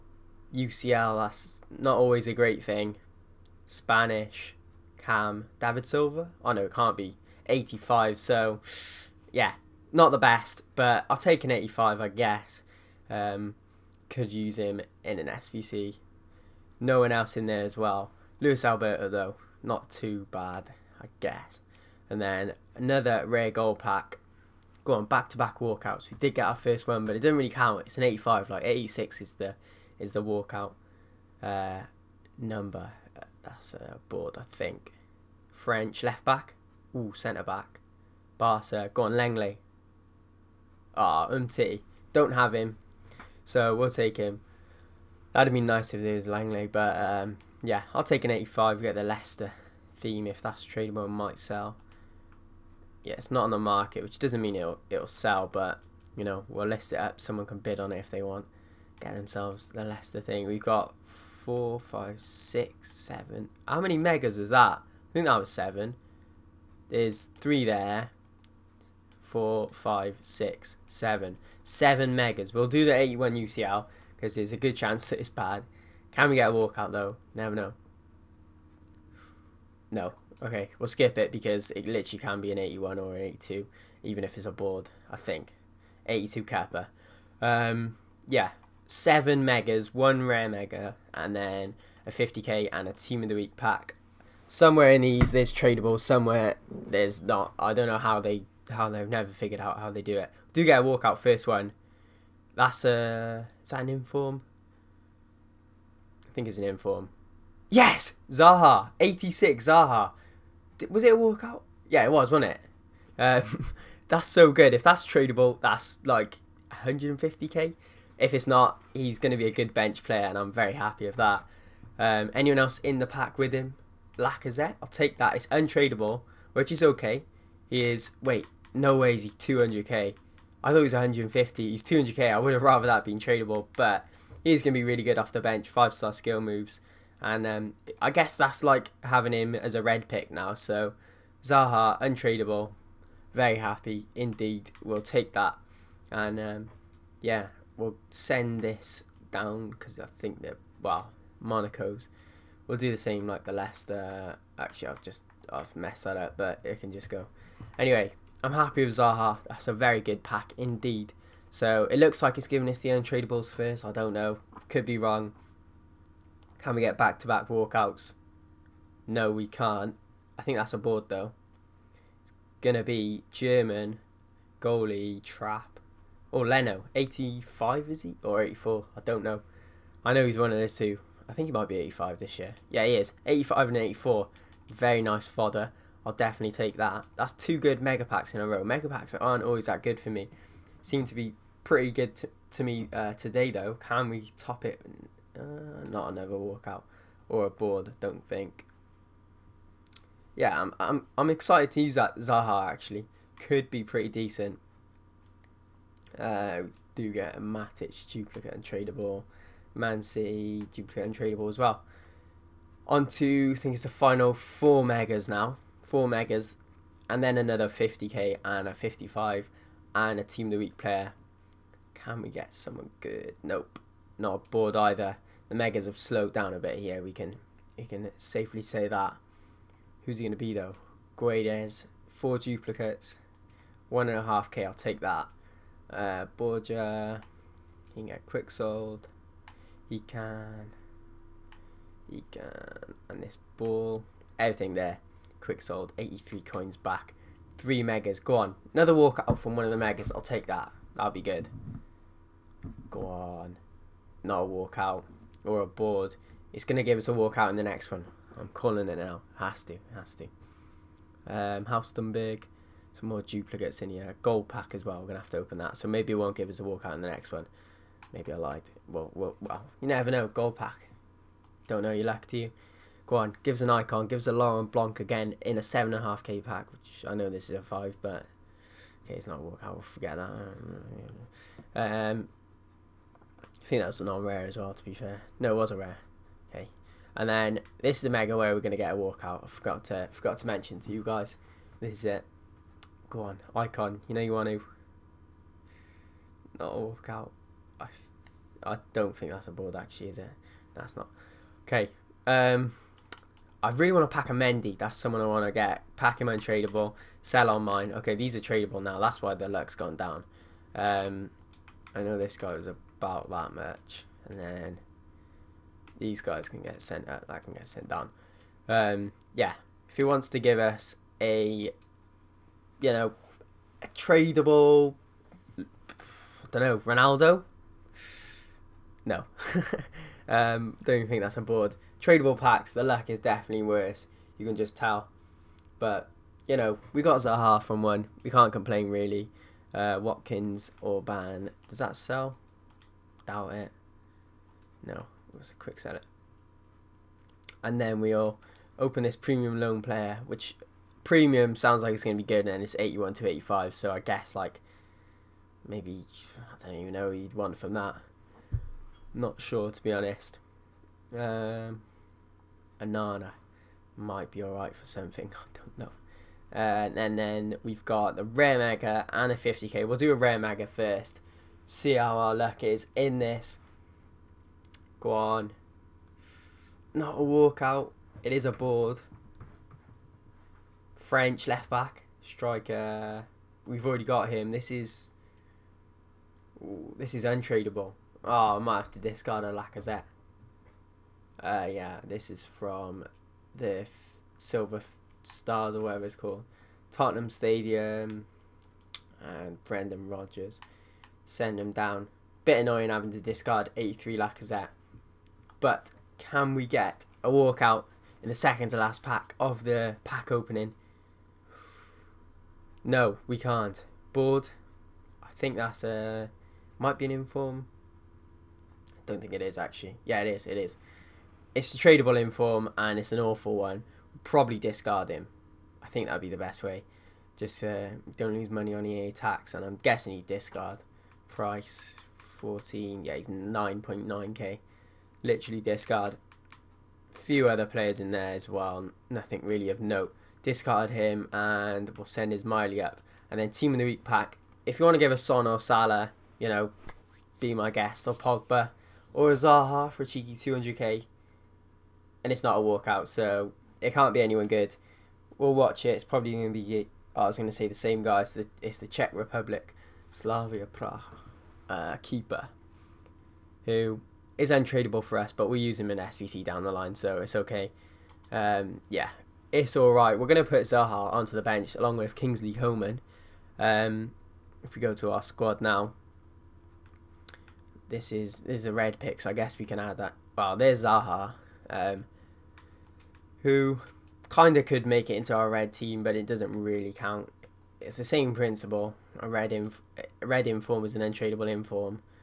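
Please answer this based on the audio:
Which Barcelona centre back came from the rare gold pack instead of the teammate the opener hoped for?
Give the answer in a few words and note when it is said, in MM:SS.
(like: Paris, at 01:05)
Umtiti, at 00:41.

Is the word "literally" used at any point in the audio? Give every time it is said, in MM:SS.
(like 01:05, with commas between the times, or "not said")
01:21, 07:15.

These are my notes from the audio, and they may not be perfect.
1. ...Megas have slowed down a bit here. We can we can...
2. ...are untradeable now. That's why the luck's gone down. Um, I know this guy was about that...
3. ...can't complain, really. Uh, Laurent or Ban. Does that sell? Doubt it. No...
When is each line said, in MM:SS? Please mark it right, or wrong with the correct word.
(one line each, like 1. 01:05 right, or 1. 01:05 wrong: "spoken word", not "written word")
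1. 03:45 right
2. 05:08 wrong: "tradable", not "untradeable"
3. 05:38 wrong: "Watkins", not "Laurent".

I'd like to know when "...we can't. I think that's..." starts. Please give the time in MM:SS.
02:49.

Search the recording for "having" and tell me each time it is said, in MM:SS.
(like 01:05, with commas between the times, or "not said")
02:19, 06:42.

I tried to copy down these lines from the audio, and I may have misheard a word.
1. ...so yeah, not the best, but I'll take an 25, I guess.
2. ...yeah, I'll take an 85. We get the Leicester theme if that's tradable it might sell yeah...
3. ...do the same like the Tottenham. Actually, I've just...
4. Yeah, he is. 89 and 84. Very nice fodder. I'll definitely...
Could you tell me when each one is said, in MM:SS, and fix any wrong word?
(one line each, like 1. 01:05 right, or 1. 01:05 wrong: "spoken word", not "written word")
1. 00:08 wrong: "85", not "25"
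2. 00:47 right
3. 02:32 wrong: "Leicester", not "Tottenham"
4. 03:02 wrong: "85", not "89".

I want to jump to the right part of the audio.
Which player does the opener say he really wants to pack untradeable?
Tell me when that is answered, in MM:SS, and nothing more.
05:04.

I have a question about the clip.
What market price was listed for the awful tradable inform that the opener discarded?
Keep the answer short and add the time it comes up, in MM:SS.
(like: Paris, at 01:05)
9.9k, at 07:13.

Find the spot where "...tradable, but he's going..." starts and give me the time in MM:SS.
02:13.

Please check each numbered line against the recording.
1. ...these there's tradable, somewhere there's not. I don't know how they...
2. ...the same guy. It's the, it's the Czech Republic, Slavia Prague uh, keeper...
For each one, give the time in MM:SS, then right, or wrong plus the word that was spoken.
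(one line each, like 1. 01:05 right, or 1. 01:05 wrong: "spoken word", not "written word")
1. 01:35 right
2. 07:37 right.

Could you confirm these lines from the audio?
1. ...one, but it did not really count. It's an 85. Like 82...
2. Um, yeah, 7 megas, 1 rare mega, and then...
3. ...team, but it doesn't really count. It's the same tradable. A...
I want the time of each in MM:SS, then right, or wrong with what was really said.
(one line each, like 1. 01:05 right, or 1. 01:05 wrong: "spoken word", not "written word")
1. 00:26 wrong: "86", not "82"
2. 01:27 right
3. 08:05 wrong: "principle", not "tradable".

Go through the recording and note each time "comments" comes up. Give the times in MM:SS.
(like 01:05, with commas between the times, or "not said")
not said.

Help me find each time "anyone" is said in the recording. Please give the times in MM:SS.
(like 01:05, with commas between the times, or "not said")
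02:02, 07:34.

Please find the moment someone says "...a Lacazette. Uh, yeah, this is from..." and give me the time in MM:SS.
06:29.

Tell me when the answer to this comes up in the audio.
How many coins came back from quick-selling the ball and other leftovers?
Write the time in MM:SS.
04:05.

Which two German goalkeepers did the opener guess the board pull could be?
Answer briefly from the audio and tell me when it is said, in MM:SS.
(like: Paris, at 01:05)
Trapp or Leno, at 02:55.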